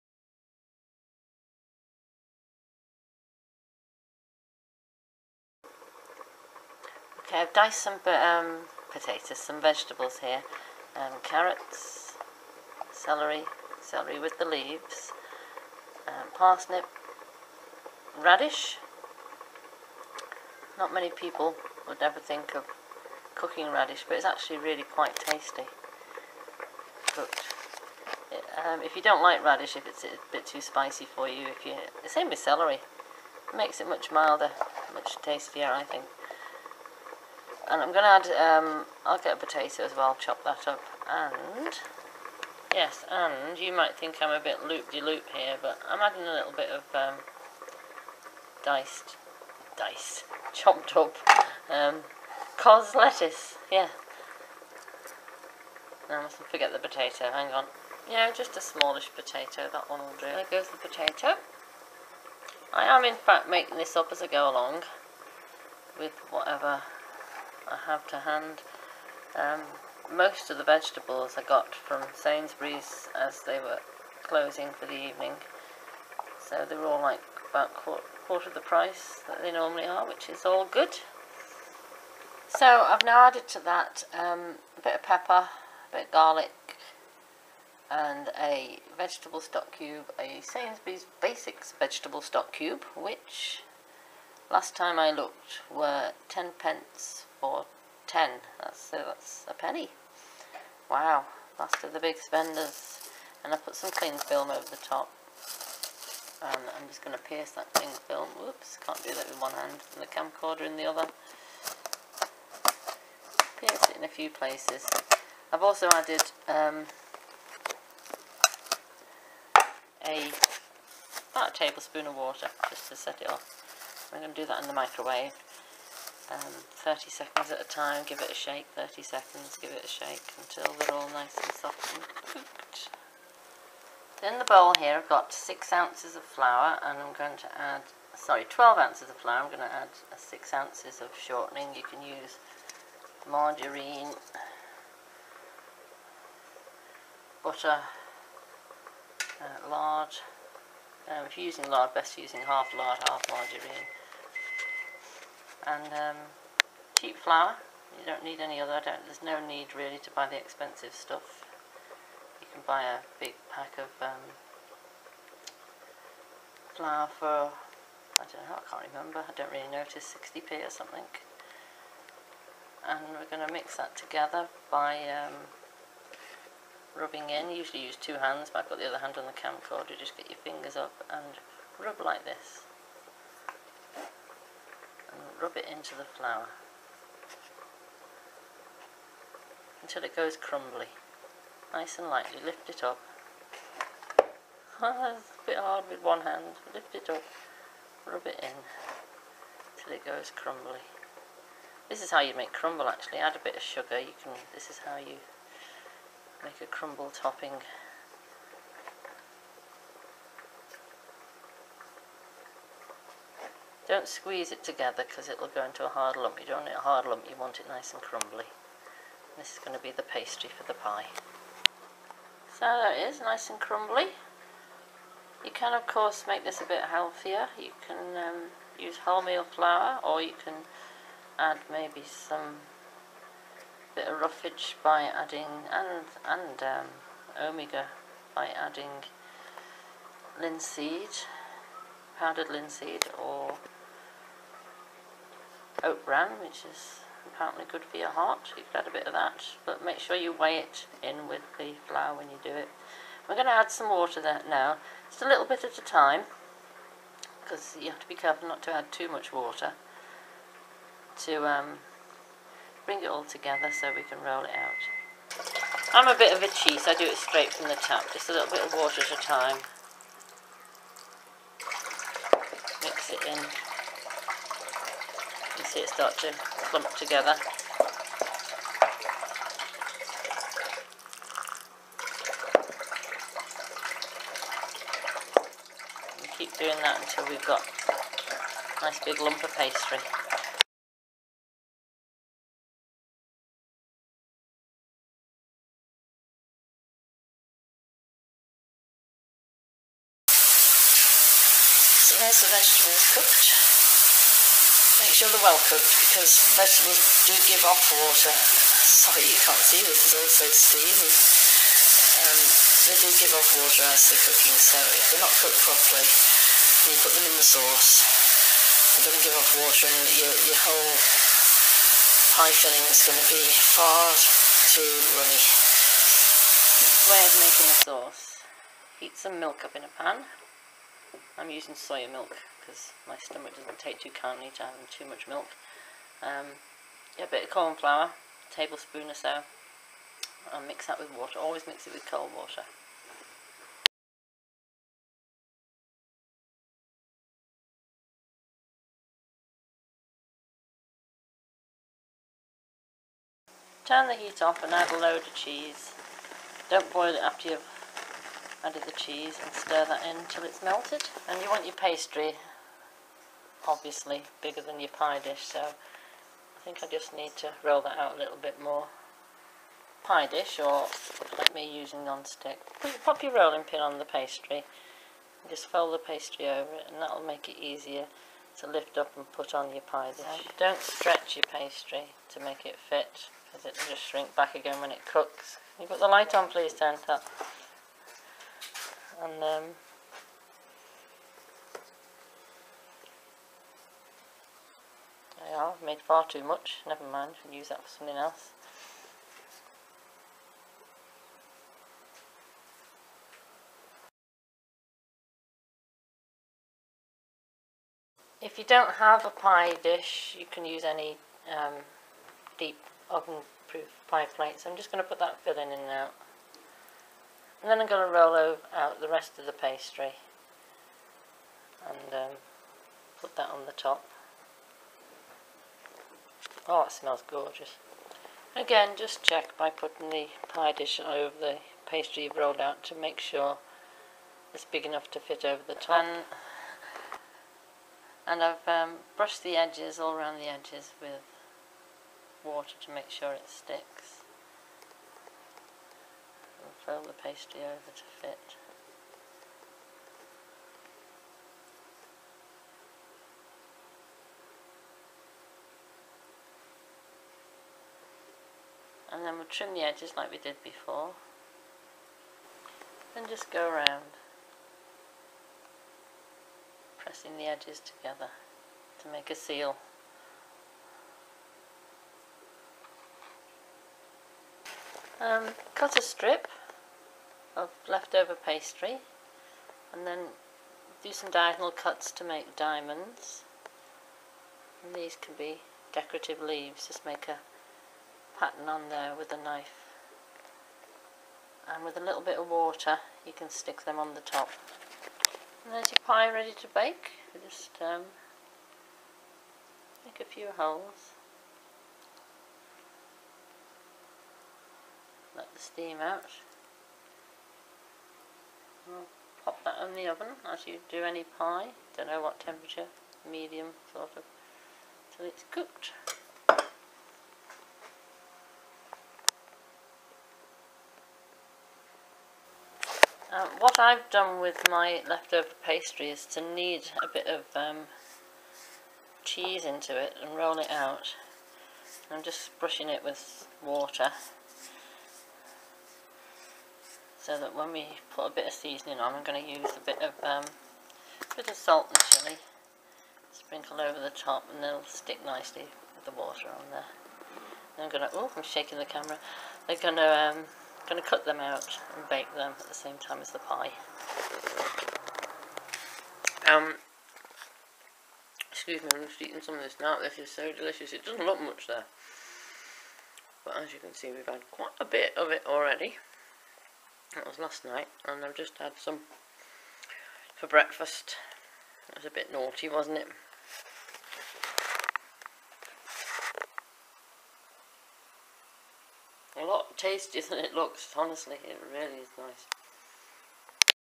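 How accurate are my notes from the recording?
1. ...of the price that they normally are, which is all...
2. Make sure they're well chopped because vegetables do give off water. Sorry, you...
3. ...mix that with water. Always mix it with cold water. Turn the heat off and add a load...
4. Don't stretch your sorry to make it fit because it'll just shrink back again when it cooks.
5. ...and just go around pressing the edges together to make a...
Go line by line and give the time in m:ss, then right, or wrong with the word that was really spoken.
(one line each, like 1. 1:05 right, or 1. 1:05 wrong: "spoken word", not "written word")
1. 1:18 right
2. 5:05 wrong: "cooked", not "chopped"
3. 5:40 right
4. 6:20 wrong: "pastry", not "sorry"
5. 7:43 right.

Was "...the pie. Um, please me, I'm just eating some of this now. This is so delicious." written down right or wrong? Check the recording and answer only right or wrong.
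wrong.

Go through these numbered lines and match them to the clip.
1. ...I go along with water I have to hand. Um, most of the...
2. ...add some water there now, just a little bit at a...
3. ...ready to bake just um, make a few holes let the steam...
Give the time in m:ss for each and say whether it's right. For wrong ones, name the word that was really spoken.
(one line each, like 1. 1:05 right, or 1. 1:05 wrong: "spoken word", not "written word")
1. 1:04 wrong: "whatever", not "water"
2. 4:13 right
3. 8:16 right.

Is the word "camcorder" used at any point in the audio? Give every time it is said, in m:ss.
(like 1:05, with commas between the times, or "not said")
1:50, 2:59.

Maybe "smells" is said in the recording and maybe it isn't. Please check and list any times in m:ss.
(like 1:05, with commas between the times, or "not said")
7:06.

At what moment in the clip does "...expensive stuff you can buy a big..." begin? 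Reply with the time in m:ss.
2:40.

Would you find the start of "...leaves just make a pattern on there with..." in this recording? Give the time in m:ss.
8:06.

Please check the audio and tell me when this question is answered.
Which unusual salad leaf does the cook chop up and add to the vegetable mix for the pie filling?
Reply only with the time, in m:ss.
0:52.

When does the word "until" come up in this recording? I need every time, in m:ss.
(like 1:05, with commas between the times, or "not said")
2:10, 3:09, 4:46.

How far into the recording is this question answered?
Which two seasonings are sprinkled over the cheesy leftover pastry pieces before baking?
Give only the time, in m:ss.
9:01.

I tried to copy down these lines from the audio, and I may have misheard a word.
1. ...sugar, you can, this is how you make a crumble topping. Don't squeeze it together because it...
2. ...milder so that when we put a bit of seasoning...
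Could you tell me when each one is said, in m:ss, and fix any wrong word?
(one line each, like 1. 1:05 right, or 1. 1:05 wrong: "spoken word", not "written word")
1. 3:23 right
2. 8:53 wrong: "water", not "milder".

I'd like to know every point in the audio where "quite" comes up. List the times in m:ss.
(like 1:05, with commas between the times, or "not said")
0:24, 9:24.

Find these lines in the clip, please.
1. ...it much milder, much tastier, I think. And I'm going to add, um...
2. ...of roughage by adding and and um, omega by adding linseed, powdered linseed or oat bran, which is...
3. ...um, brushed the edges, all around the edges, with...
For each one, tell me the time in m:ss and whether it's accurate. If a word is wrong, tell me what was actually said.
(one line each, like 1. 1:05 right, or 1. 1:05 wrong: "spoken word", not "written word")
1. 0:33 right
2. 3:54 right
3. 7:18 right.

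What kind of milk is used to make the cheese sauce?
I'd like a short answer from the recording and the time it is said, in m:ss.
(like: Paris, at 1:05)
soya milk, at 5:31.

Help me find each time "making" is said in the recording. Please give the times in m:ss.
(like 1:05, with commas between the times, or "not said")
1:03, 5:27.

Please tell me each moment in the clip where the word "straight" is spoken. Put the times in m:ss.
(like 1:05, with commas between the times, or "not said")
4:27.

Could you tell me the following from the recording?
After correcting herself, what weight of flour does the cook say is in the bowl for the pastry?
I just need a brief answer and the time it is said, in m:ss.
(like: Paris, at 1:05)
12 ounces, at 2:18.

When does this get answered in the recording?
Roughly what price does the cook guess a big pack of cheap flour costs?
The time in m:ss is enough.
2:50.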